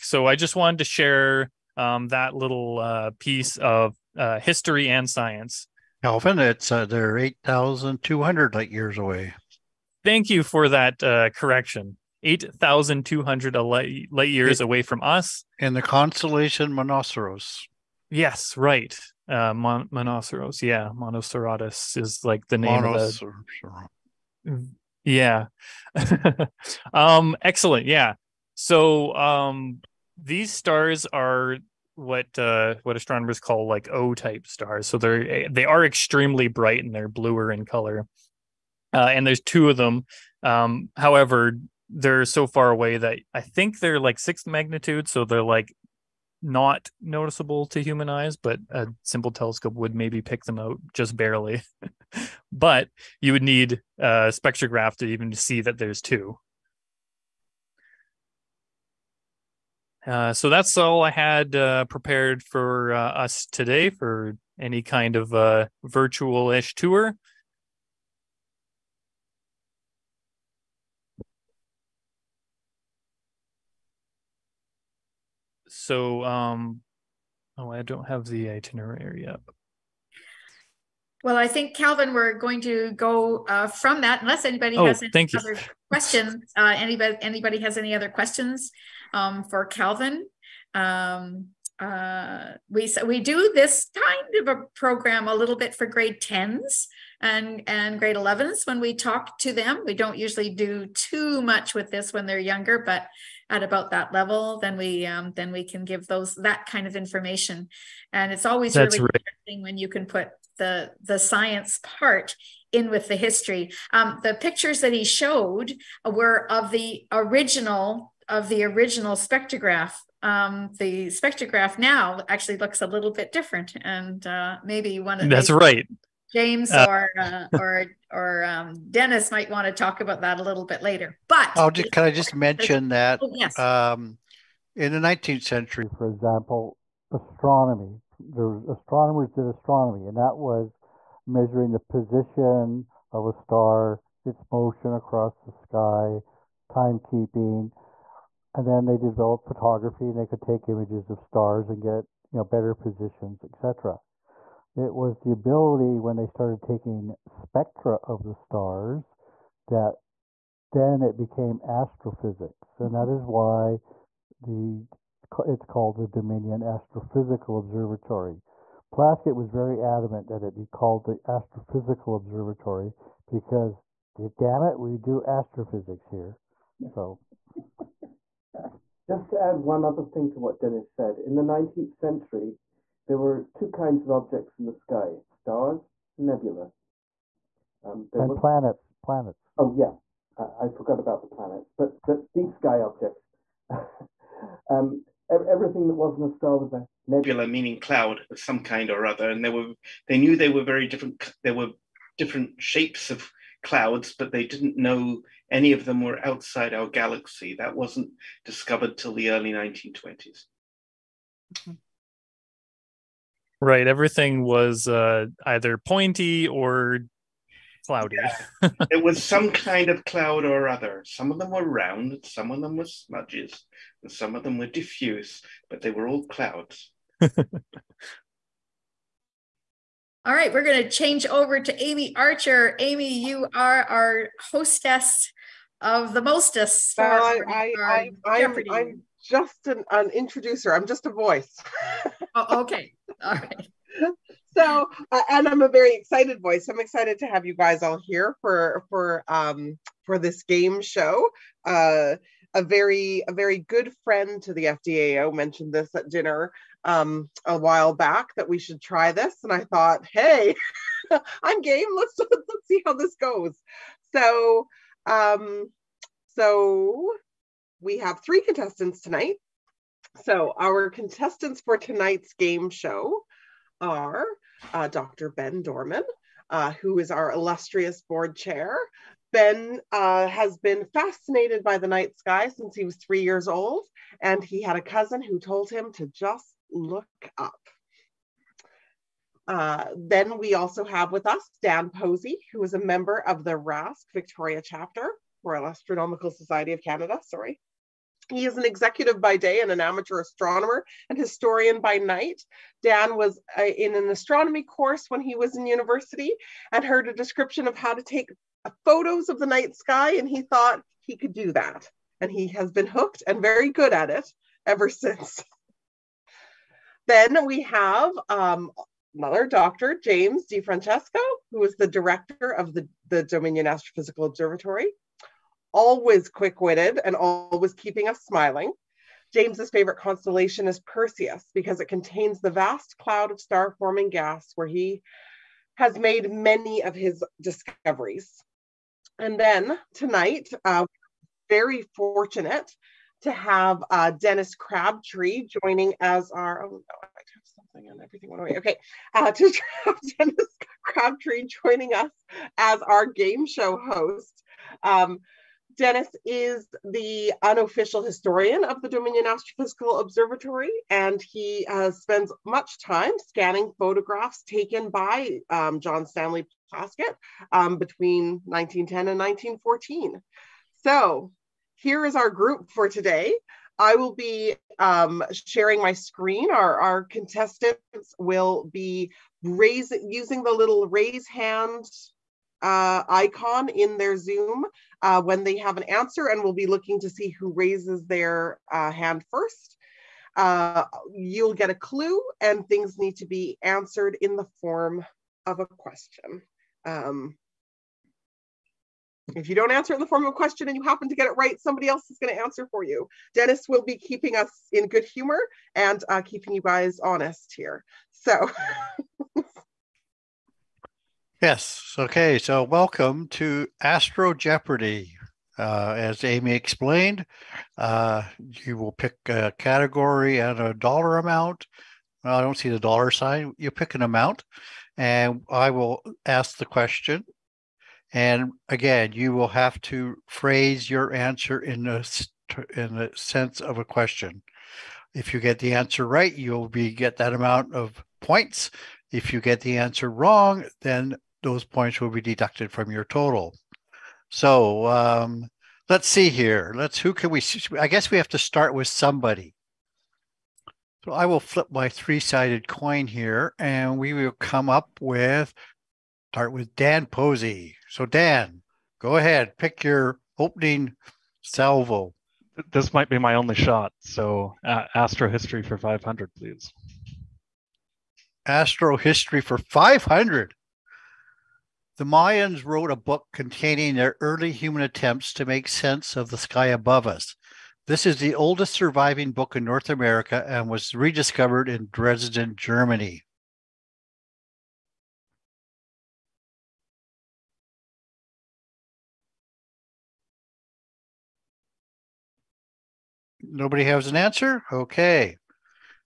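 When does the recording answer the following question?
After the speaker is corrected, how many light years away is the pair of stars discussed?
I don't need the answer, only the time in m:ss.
0:07.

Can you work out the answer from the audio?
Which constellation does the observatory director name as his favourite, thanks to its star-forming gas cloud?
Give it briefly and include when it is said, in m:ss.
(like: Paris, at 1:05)
Perseus, at 5:30.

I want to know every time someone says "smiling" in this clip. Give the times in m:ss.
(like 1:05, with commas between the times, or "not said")
5:28.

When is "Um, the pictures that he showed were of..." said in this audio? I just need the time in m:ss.
1:53.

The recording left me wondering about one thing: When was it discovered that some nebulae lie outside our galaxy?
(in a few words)
Early 1920s.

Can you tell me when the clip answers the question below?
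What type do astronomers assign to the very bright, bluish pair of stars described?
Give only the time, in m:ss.
0:33.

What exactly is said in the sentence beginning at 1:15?
So, um, oh, I don't have the itinerary up.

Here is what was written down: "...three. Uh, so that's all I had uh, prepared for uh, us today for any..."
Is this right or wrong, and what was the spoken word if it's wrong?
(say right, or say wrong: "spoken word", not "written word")
wrong: "two", not "three".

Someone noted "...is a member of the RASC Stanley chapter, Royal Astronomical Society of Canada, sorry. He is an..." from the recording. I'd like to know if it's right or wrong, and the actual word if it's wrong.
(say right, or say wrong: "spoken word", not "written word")
wrong: "Victoria", not "Stanley".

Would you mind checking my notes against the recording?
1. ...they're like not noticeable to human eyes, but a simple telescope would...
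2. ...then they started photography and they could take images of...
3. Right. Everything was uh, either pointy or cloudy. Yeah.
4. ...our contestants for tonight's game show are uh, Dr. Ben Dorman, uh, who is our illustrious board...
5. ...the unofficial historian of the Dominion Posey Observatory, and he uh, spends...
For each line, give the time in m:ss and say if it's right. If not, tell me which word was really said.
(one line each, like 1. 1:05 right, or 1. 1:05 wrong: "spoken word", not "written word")
1. 0:45 right
2. 2:28 wrong: "developed", not "started"
3. 3:33 right
4. 4:30 right
5. 5:56 wrong: "Astrophysical", not "Posey".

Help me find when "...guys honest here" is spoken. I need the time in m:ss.
6:46.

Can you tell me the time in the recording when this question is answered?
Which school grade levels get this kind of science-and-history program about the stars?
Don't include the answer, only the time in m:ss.
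1:35.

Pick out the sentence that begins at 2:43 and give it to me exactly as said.
is why the it's called the Dominion Astrophysical Observatory.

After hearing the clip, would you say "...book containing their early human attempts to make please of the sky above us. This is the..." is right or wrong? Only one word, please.
wrong.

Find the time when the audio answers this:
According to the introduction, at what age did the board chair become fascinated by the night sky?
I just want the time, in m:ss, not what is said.
4:42.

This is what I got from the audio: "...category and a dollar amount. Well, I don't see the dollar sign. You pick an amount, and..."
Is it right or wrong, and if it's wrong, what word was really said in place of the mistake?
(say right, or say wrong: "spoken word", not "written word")
right.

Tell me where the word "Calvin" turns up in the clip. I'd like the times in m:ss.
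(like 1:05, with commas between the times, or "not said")
0:06, 1:21, 1:29.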